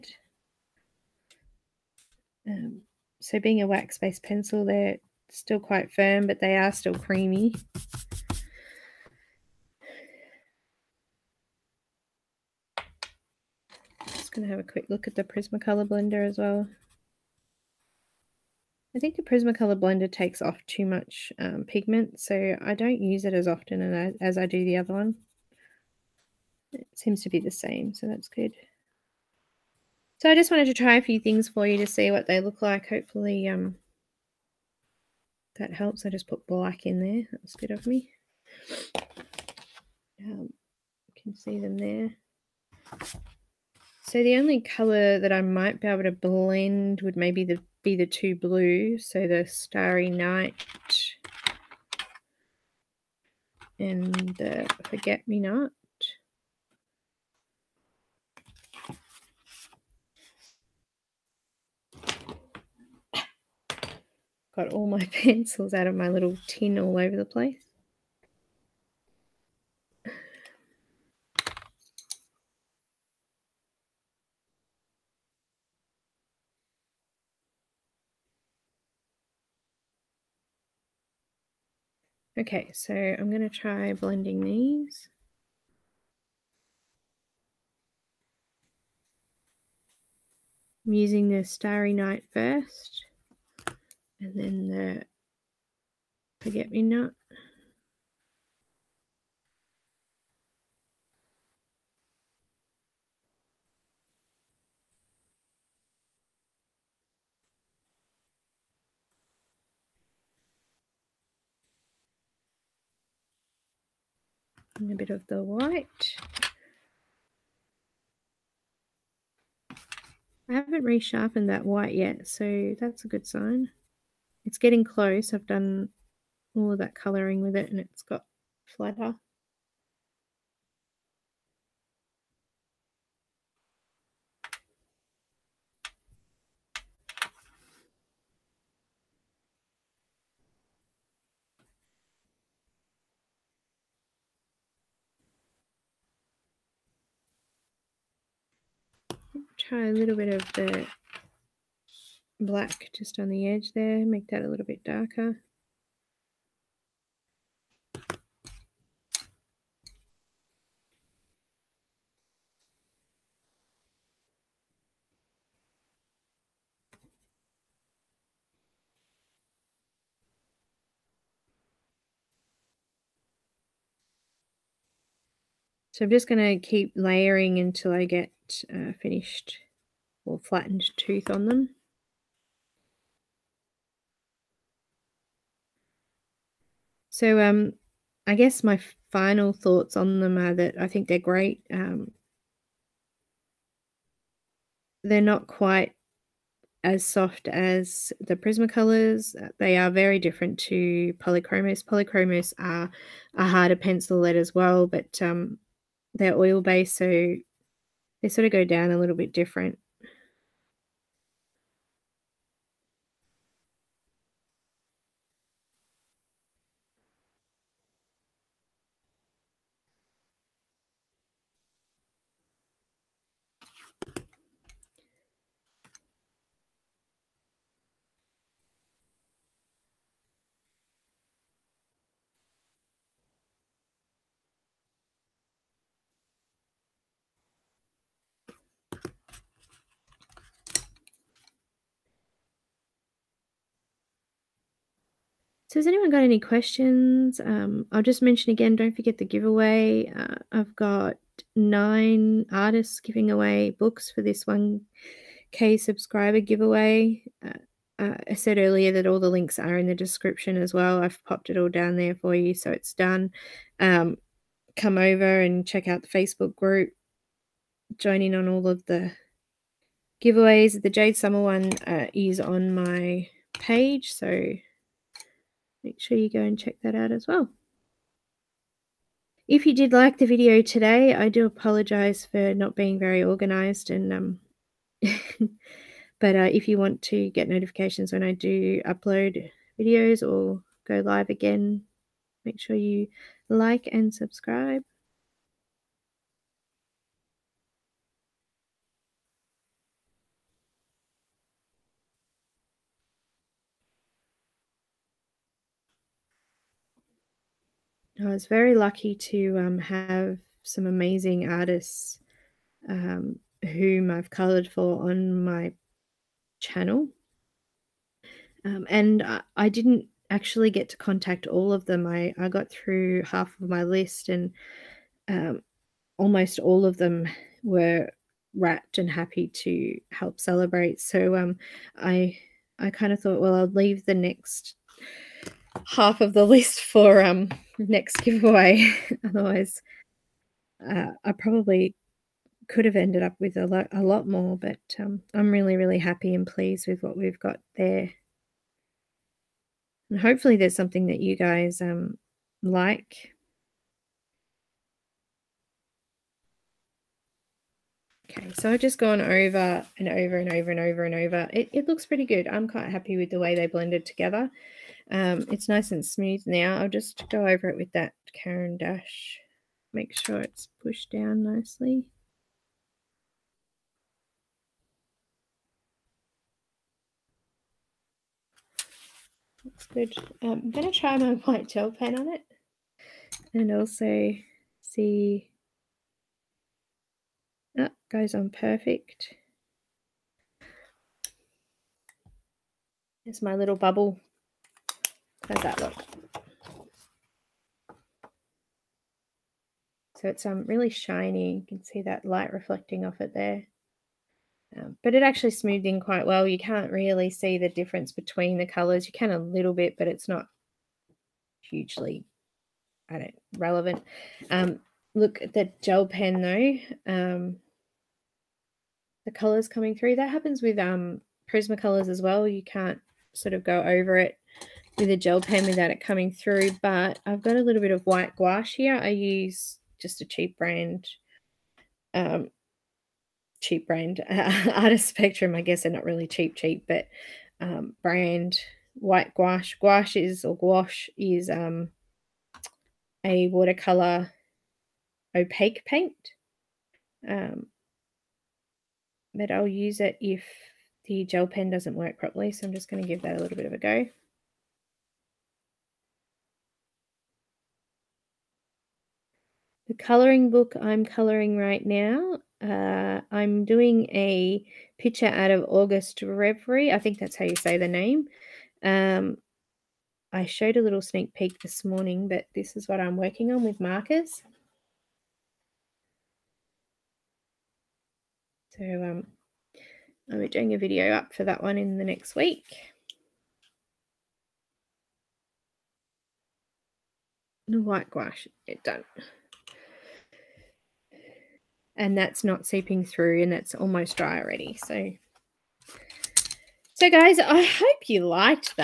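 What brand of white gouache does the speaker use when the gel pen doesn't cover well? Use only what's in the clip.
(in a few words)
Artist Spectrum.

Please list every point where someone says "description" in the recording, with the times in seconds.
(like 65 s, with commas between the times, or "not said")
259 s.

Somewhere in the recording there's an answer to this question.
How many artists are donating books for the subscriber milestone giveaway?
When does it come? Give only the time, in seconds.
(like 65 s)
251 s.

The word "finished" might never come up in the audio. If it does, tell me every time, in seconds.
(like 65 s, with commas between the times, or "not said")
178 s.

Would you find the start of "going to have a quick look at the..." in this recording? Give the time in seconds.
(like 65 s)
14 s.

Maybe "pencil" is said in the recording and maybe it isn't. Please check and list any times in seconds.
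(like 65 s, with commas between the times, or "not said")
4 s, 65 s, 203 s.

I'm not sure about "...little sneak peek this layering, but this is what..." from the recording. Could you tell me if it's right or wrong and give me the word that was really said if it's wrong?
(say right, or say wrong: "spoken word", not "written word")
wrong: "morning", not "layering".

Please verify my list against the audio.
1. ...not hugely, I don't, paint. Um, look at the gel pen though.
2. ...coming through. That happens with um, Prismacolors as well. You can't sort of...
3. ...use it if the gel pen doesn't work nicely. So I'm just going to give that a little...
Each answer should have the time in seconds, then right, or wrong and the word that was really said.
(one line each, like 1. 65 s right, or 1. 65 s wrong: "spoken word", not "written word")
1. 410 s wrong: "relevant", not "paint"
2. 419 s right
3. 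449 s wrong: "properly", not "nicely".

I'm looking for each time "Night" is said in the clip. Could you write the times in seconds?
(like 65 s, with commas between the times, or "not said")
50 s, 91 s.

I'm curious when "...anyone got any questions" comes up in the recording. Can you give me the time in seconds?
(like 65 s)
245 s.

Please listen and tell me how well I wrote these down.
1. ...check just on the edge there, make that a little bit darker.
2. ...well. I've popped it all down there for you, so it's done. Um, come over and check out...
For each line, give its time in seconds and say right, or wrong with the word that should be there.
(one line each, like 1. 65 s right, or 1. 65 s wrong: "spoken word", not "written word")
1. 152 s wrong: "black", not "check"
2. 260 s right.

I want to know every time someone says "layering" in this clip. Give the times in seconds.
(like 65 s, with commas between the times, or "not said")
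176 s.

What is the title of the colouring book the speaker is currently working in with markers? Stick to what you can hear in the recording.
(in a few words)
August Reverie.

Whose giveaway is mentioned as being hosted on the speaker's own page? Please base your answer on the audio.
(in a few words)
Jade Summer.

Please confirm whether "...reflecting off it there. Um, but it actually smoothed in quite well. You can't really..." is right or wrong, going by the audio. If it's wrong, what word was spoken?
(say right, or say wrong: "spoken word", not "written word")
right.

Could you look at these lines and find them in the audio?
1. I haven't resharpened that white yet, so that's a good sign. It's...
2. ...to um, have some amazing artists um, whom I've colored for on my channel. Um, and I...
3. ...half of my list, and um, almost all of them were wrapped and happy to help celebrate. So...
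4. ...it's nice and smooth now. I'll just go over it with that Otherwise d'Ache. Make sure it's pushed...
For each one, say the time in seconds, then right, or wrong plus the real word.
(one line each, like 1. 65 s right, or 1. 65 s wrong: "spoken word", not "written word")
1. 120 s right
2. 309 s right
3. 323 s right
4. 365 s wrong: "Caran", not "Otherwise".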